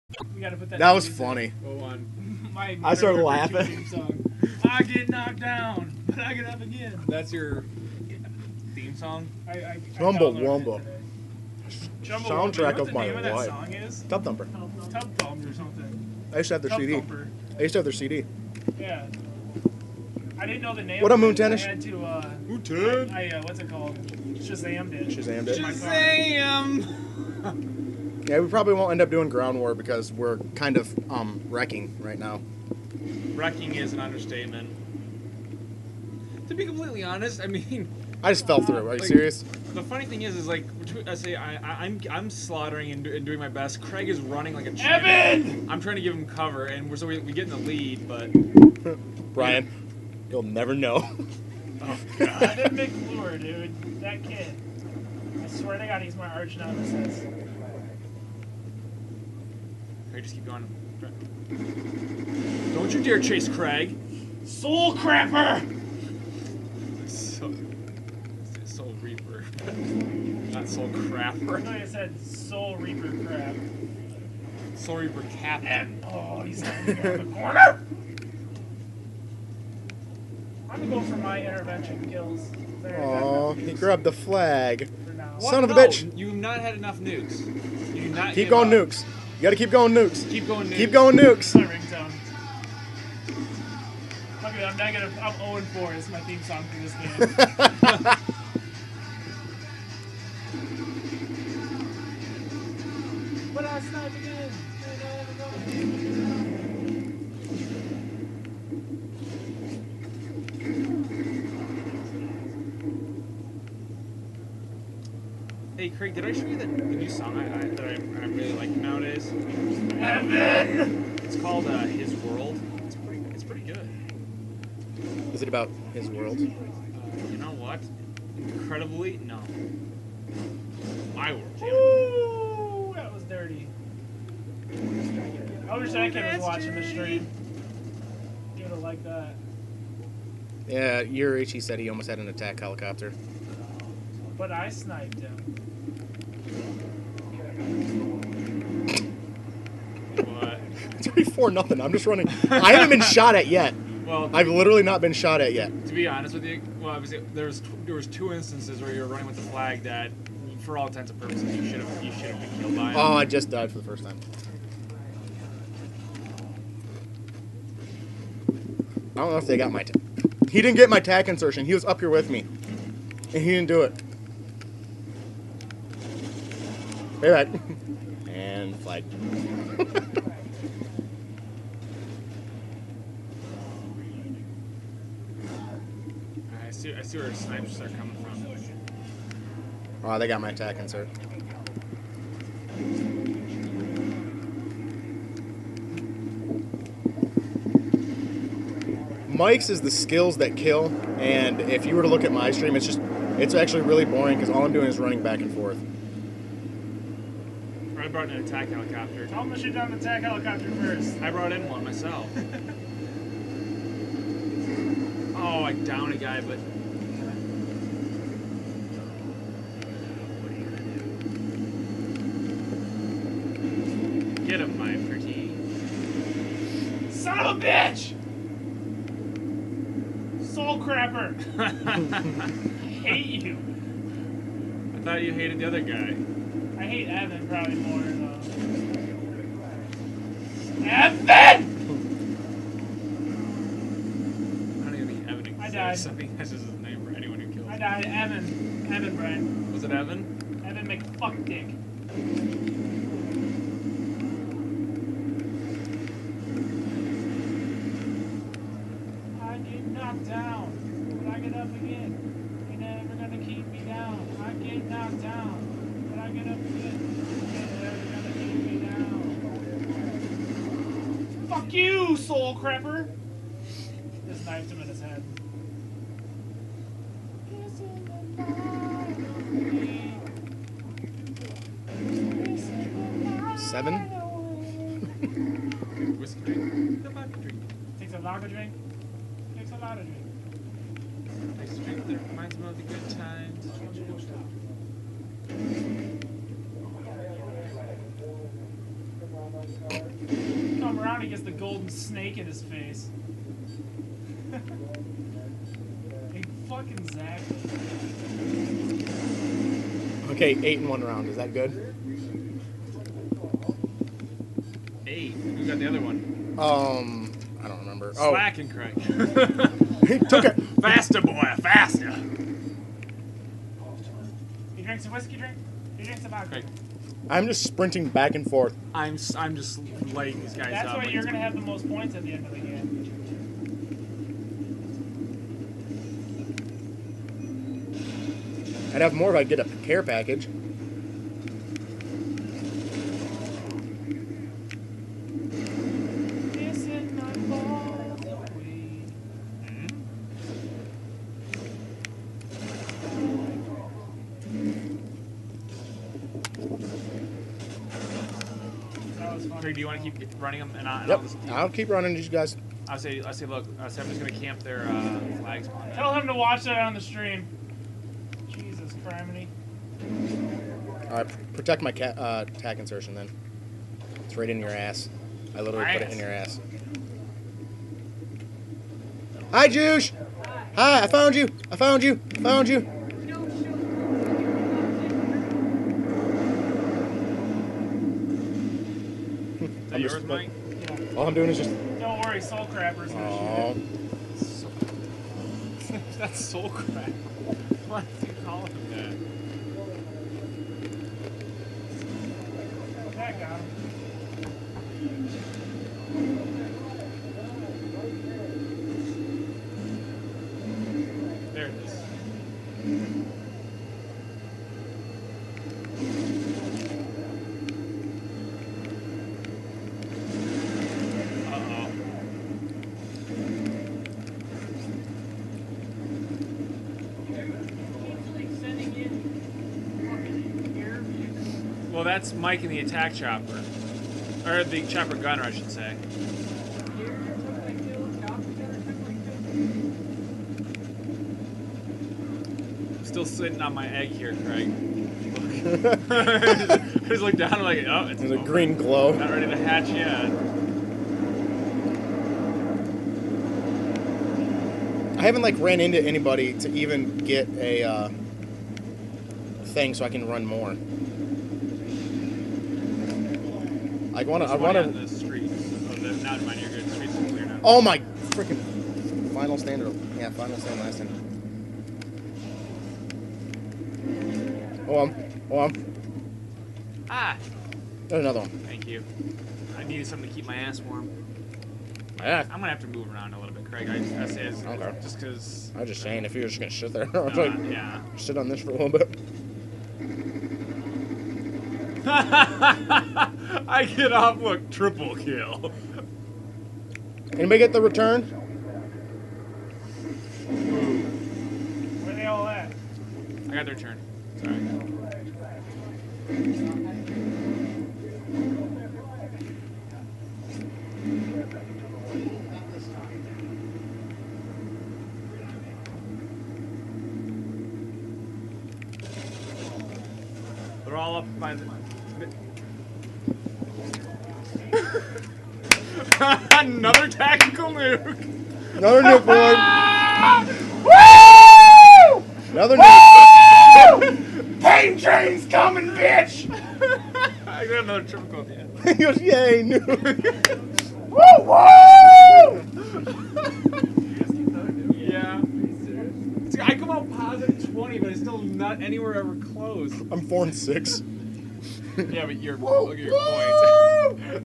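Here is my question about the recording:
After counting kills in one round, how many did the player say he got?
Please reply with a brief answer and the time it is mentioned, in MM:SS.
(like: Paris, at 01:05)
8, at 05:10.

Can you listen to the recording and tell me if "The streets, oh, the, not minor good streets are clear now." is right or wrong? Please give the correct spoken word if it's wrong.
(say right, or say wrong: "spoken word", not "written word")
right.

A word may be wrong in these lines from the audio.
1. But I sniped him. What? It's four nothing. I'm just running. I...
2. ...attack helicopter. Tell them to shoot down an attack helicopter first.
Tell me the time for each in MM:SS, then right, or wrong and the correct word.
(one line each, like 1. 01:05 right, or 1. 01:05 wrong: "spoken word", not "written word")
1. 02:24 right
2. 03:28 right.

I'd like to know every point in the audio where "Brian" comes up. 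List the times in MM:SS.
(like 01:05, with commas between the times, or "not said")
00:49, 04:09.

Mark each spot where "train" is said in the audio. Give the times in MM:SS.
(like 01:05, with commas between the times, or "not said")
08:54.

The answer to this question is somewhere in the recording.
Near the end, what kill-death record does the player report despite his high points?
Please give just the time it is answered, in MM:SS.
09:10.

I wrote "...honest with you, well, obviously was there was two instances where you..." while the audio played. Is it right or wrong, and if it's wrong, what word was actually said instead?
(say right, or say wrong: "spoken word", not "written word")
right.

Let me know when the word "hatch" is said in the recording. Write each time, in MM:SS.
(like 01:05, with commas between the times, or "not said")
07:29.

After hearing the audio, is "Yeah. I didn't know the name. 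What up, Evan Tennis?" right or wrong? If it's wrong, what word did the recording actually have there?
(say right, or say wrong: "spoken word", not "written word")
wrong: "Moon", not "Evan".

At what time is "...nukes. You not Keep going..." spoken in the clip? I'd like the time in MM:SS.
01:26.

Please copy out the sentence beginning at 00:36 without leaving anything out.
To be completely honest, I mean.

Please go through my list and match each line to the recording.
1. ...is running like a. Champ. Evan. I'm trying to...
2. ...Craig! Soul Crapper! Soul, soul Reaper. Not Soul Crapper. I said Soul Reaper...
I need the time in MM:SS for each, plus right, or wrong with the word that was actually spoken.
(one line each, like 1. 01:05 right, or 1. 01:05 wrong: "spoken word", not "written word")
1. 00:44 right
2. 01:03 right.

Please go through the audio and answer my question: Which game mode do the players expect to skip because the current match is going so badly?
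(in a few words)
Ground war.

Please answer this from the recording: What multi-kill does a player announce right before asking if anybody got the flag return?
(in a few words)
Triple kill.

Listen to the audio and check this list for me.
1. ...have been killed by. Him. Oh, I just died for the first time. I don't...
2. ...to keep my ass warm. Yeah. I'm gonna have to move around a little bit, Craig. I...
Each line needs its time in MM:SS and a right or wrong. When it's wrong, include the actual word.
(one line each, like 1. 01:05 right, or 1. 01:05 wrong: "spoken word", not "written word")
1. 02:42 right
2. 08:00 right.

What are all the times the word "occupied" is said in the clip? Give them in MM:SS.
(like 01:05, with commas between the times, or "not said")
not said.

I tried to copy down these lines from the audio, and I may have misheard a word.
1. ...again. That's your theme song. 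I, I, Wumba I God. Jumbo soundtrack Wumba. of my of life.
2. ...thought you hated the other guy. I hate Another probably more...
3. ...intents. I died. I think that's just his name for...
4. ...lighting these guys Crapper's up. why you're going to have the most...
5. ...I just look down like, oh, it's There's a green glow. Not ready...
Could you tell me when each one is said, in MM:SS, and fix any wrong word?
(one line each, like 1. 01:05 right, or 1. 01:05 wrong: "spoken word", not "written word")
1. 00:06 wrong: "Wumba", not "God"
2. 03:55 wrong: "Evan", not "Another"
3. 04:05 wrong: "exists", not "intents"
4. 05:30 wrong: "That", not "Crapper"
5. 07:26 right.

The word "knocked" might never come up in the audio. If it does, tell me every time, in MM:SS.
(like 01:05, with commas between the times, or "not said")
00:05, 04:19, 04:24.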